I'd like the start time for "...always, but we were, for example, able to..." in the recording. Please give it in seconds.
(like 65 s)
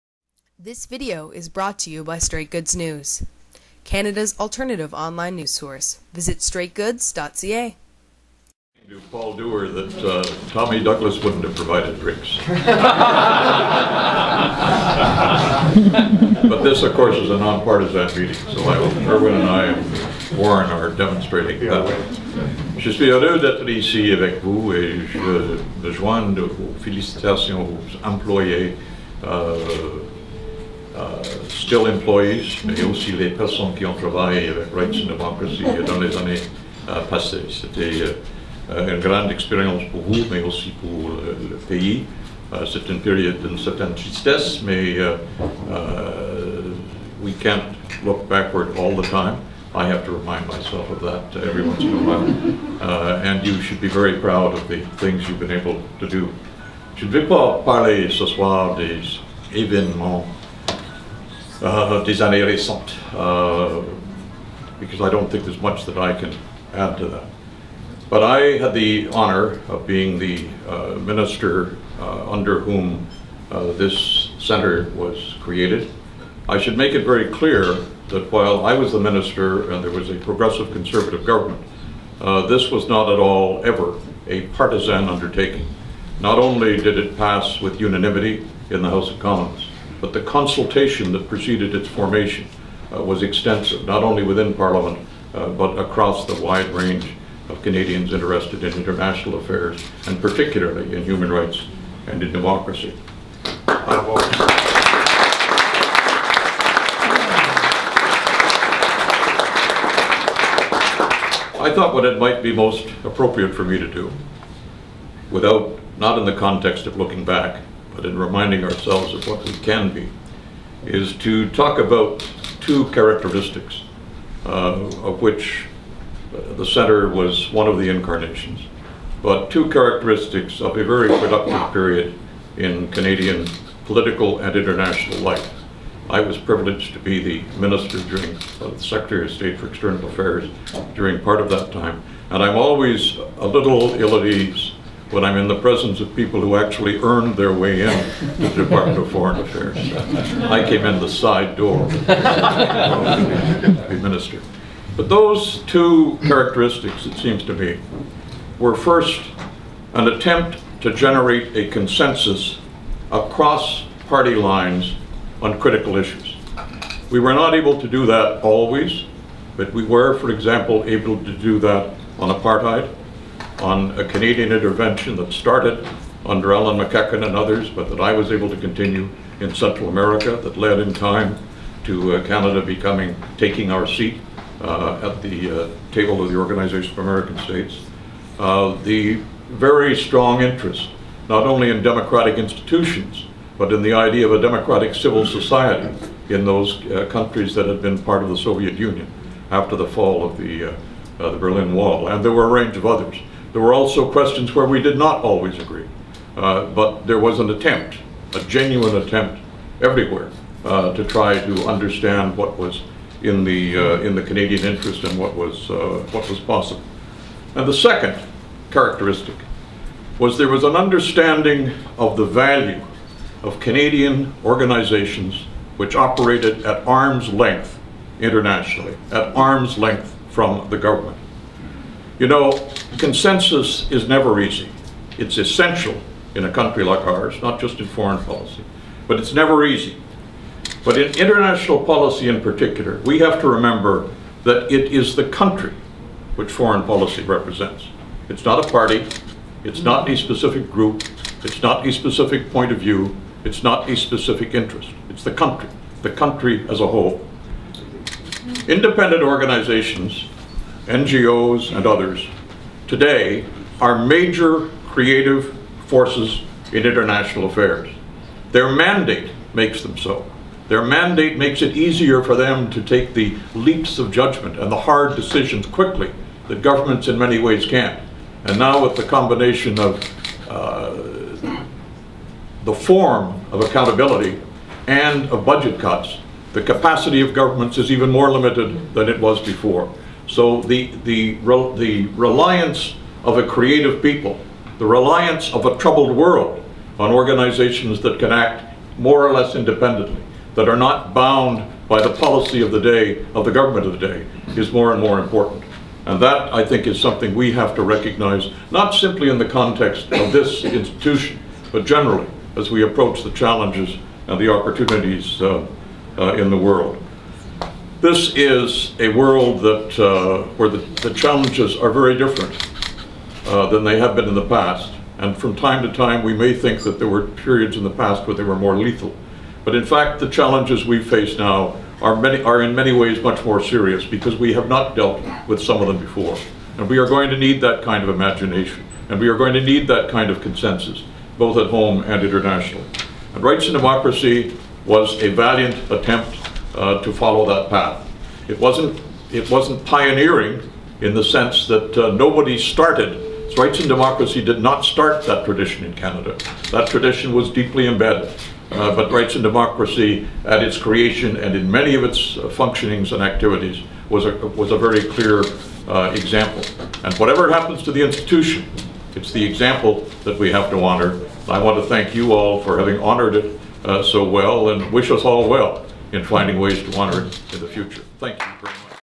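168 s.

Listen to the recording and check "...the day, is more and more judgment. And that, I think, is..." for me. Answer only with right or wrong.
wrong.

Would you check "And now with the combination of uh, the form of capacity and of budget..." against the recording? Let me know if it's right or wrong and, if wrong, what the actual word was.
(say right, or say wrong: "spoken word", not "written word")
wrong: "accountability", not "capacity".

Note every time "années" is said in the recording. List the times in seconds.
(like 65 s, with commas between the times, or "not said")
36 s, 62 s.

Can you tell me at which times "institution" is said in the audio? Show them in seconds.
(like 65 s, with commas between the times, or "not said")
192 s, 310 s, 368 s.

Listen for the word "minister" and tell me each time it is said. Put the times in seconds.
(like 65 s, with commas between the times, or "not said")
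70 s, 78 s, 137 s, 154 s.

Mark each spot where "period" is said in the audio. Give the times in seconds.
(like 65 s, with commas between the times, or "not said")
131 s, 327 s.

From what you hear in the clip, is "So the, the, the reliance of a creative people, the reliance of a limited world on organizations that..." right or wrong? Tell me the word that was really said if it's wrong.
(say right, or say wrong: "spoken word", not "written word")
wrong: "troubled", not "limited".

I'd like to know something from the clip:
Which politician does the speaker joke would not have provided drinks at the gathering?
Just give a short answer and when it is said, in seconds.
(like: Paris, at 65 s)
Tommy Douglas, at 10 s.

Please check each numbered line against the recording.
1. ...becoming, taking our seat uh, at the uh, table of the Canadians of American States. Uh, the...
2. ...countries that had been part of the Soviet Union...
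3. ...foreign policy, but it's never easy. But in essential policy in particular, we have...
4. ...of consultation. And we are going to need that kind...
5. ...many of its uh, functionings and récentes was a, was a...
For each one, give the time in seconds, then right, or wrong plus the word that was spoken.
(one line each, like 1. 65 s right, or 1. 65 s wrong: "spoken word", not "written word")
1. 182 s wrong: "Organization", not "Canadians"
2. 197 s right
3. 237 s wrong: "international", not "essential"
4. 338 s wrong: "imagination", not "consultation"
5. 361 s wrong: "activities", not "récentes".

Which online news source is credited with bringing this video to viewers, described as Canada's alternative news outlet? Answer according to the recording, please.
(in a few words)
Straight Goods News.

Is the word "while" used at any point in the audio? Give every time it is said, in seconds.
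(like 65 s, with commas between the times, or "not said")
52 s, 78 s.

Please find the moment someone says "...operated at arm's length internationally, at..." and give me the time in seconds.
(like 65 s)
225 s.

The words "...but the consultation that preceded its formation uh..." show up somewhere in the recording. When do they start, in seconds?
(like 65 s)
90 s.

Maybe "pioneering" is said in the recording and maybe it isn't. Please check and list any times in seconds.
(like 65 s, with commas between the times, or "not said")
349 s.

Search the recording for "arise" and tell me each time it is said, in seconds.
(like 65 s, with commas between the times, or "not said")
not said.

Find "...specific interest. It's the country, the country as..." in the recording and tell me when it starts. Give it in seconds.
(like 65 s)
253 s.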